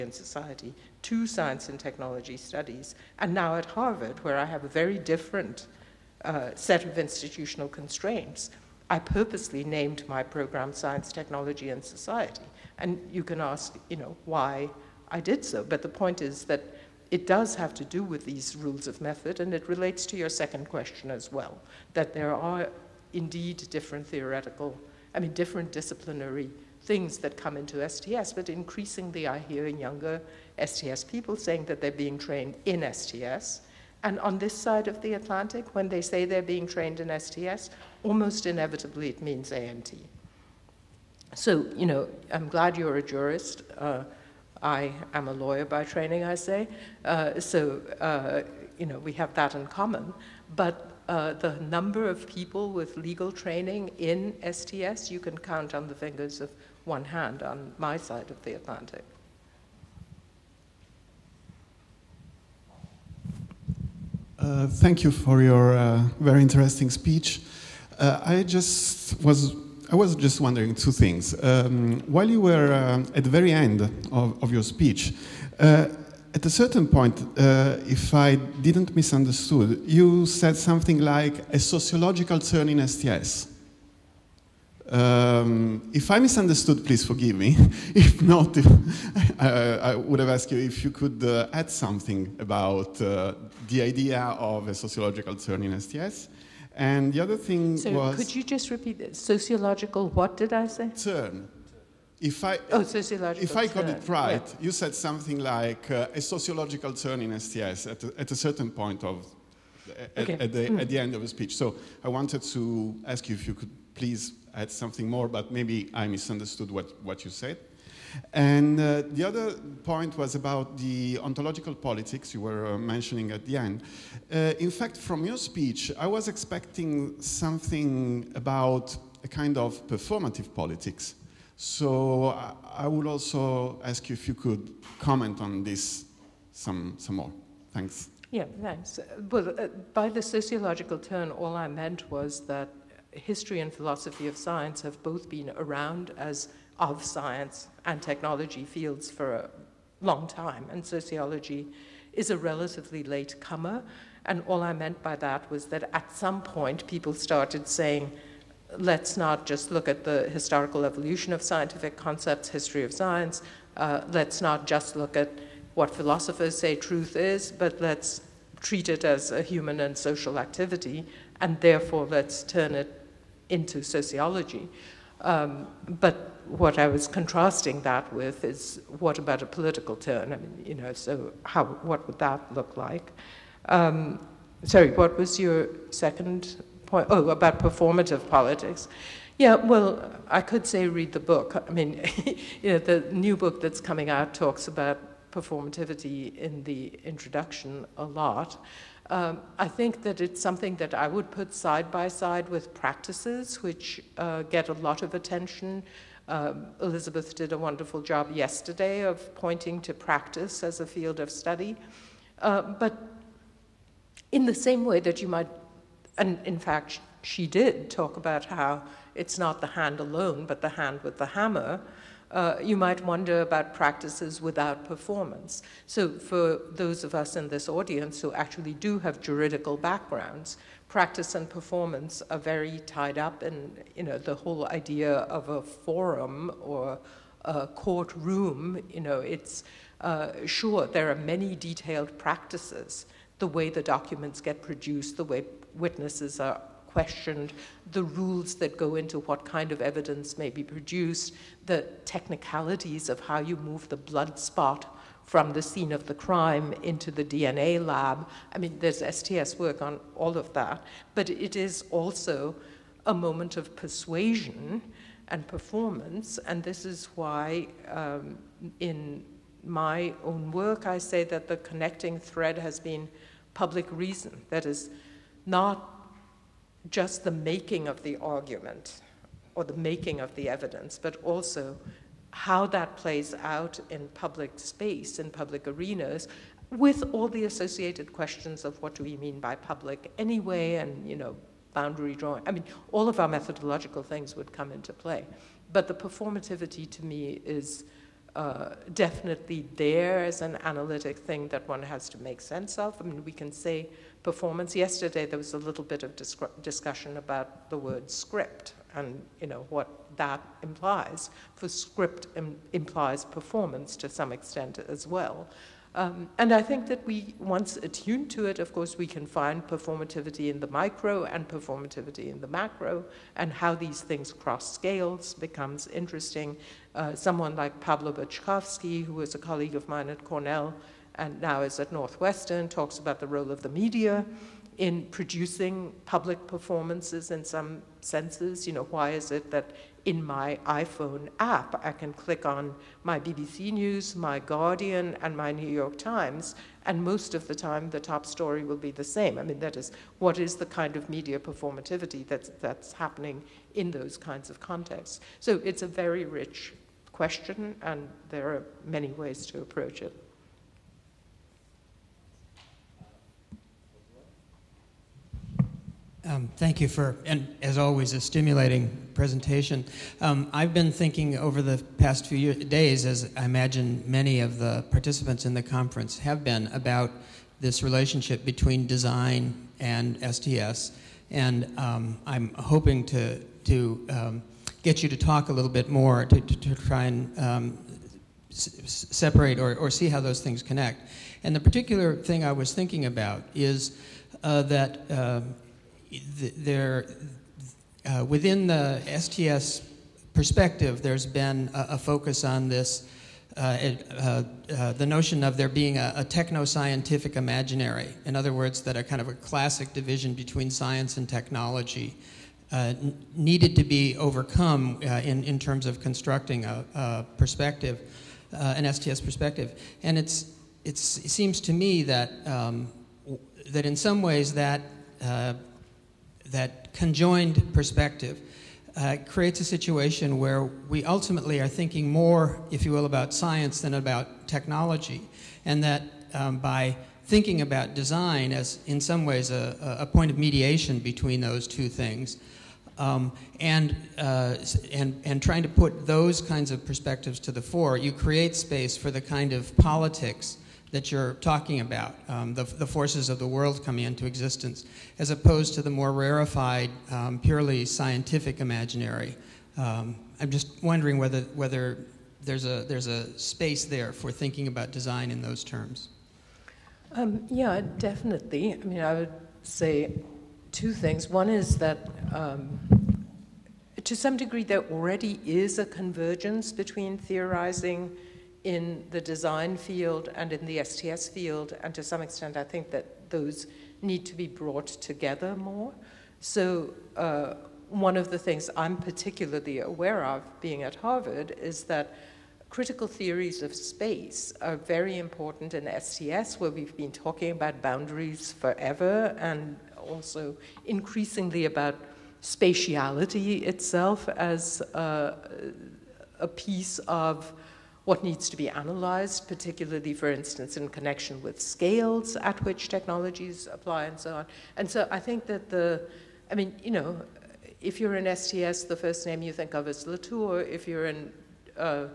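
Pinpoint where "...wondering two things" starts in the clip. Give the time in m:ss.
1:10.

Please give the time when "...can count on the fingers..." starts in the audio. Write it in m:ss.
0:55.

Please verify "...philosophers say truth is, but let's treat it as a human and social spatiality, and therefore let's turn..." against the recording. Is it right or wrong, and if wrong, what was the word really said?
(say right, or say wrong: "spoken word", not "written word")
wrong: "activity", not "spatiality".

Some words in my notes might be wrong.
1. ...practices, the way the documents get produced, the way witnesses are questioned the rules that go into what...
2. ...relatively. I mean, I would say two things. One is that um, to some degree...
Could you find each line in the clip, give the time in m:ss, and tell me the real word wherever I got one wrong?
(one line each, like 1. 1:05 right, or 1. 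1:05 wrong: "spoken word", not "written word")
1. 4:02 right
2. 7:47 wrong: "definitely", not "relatively".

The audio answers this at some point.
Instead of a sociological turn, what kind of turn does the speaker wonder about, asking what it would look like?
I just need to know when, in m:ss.
2:59.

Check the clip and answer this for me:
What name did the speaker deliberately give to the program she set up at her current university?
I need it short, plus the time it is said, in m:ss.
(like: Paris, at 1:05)
Science, Technology, and Society, at 0:10.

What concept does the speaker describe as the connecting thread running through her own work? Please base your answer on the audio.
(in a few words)
public reason.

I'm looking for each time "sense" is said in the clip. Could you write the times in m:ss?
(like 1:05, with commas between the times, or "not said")
5:02, 5:38.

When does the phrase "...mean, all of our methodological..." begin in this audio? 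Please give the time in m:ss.
4:52.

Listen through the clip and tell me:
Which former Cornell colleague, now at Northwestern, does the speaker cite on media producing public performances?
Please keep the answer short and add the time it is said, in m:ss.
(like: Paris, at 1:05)
Pablo Boczkowski, at 5:27.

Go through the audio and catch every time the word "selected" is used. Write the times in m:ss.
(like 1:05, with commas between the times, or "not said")
not said.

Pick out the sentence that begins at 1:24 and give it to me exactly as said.
Um, if I misunderstood, please forgive me.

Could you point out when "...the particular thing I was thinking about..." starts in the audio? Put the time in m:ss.
6:31.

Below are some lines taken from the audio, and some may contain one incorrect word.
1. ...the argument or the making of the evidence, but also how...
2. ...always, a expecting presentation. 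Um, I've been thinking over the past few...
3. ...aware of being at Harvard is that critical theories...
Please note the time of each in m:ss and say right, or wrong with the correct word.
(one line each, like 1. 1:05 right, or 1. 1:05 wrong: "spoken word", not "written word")
1. 4:38 right
2. 6:07 wrong: "stimulating", not "expecting"
3. 8:09 right.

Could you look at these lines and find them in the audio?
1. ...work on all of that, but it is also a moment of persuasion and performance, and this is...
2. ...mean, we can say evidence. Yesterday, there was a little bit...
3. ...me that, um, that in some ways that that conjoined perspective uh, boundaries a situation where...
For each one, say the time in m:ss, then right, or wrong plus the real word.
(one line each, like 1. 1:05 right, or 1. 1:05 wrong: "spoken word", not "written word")
1. 4:19 right
2. 5:03 wrong: "performance", not "evidence"
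3. 7:01 wrong: "creates", not "boundaries".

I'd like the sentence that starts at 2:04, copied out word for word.
Uh, in fact, from your speech, I was expecting something about a kind of performative politics.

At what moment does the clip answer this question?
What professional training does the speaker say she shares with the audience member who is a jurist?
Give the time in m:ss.
0:45.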